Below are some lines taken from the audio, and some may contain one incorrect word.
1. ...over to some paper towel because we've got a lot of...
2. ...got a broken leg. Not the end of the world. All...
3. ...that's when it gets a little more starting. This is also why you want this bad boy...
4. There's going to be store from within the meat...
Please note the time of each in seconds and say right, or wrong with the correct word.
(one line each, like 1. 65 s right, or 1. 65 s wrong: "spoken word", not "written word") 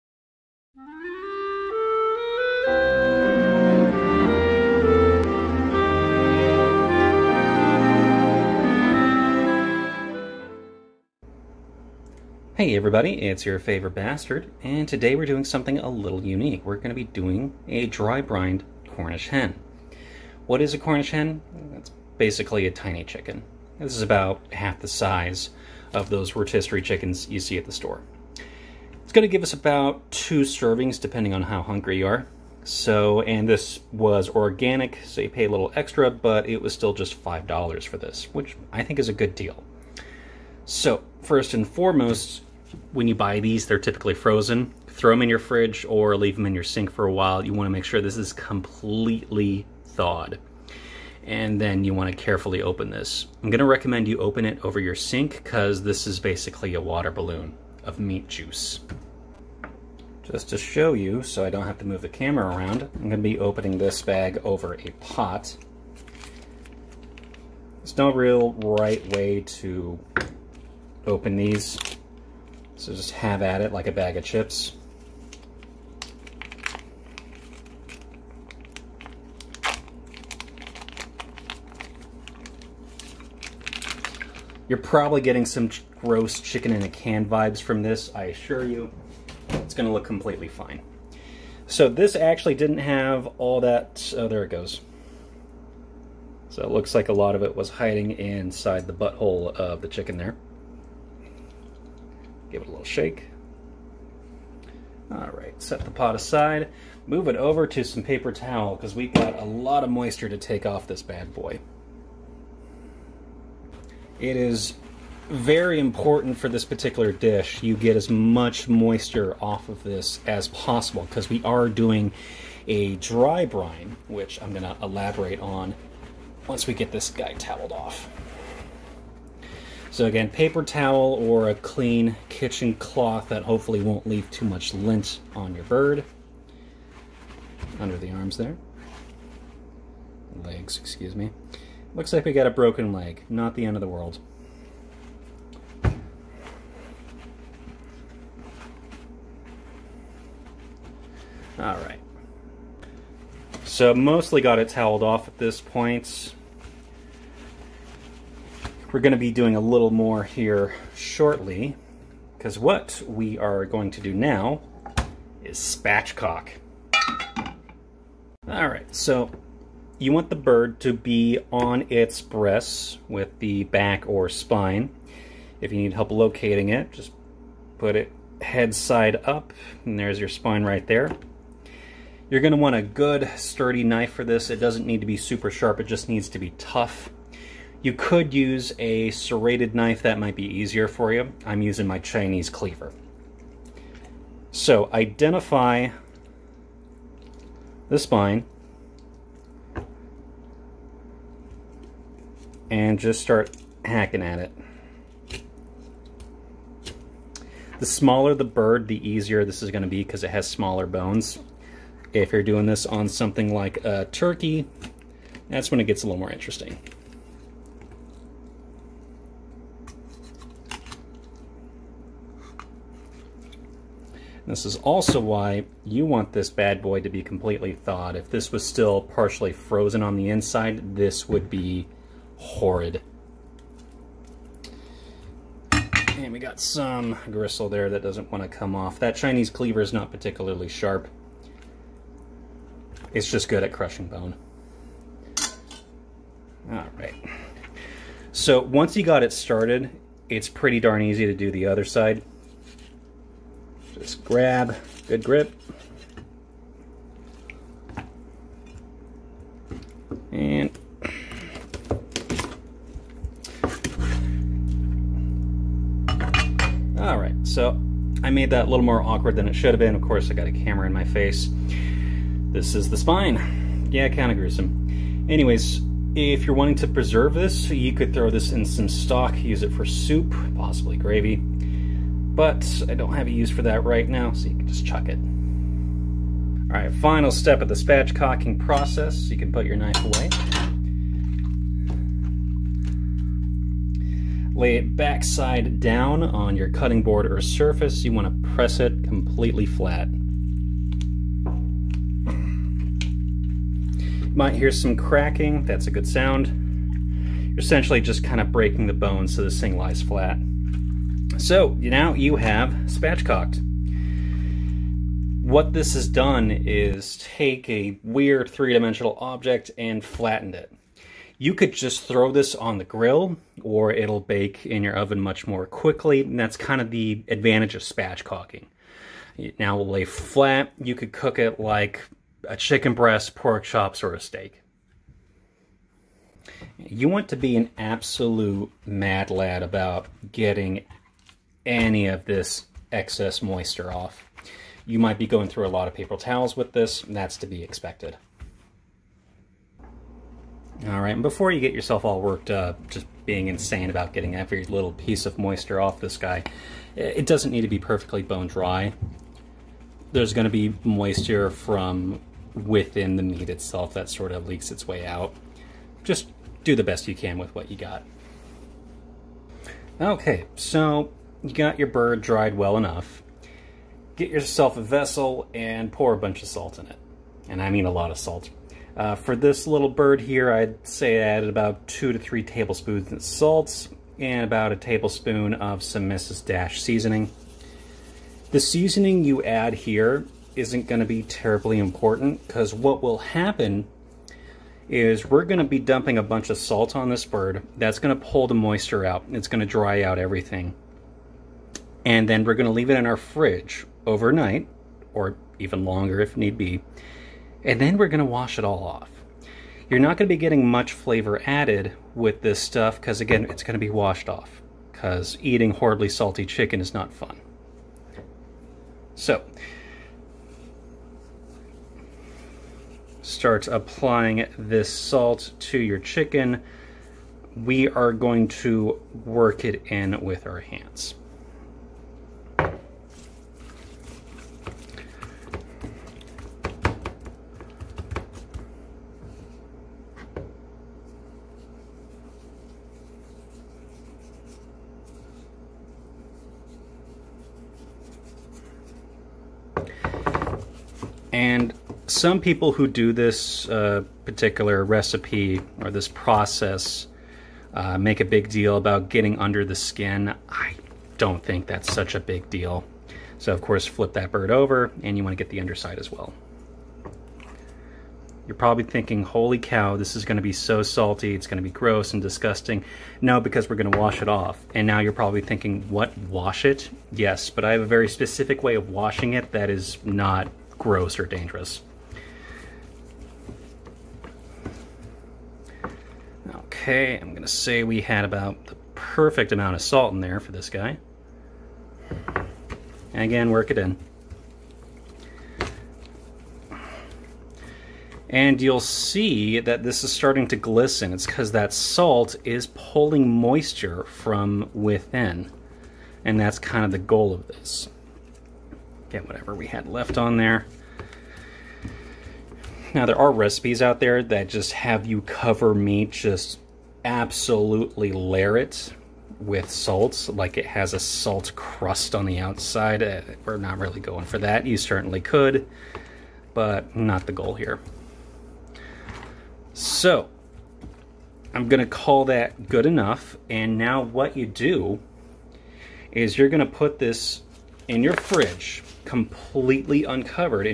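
1. 107 s right
2. 142 s right
3. 215 s wrong: "interesting", not "starting"
4. 360 s wrong: "moisture", not "store".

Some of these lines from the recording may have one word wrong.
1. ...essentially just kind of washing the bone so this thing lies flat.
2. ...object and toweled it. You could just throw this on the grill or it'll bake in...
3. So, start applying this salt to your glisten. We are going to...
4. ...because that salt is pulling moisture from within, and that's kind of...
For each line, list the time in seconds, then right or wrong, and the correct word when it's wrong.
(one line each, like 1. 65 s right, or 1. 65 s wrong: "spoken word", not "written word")
1. 307 s wrong: "breaking", not "washing"
2. 319 s wrong: "flattened", not "toweled"
3. 419 s wrong: "chicken", not "glisten"
4. 501 s right.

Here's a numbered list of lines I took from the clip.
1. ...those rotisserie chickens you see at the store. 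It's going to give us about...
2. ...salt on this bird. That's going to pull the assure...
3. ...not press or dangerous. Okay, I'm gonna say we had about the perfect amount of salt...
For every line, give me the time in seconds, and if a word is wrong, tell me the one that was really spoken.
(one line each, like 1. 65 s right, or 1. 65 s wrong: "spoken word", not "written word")
1. 26 s right
2. 396 s wrong: "moisture", not "assure"
3. 480 s wrong: "gross", not "press".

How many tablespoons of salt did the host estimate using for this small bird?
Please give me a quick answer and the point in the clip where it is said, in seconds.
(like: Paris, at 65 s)
2 to 3, at 381 s.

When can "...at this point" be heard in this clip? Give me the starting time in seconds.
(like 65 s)
155 s.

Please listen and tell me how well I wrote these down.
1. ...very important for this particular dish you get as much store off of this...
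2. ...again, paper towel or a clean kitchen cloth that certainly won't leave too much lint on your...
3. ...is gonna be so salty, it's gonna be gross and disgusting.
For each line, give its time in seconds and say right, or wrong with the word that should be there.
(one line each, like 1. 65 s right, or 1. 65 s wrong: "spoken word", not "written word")
1. 115 s wrong: "moisture", not "store"
2. 130 s wrong: "hopefully", not "certainly"
3. 470 s right.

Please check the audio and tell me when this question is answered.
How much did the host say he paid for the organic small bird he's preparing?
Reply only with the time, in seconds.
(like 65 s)
37 s.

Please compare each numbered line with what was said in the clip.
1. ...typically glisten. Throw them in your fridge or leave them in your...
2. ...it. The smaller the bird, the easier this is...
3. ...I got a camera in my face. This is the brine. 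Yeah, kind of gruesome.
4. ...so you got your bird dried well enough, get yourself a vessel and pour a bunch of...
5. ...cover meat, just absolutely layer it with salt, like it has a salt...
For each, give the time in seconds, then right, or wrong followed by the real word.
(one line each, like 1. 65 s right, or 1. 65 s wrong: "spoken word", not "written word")
1. 43 s wrong: "frozen", not "glisten"
2. 204 s right
3. 270 s wrong: "spine", not "brine"
4. 370 s right
5. 515 s right.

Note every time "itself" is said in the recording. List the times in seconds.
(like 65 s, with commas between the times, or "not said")
363 s.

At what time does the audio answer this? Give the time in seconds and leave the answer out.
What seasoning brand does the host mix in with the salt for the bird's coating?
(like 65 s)
386 s.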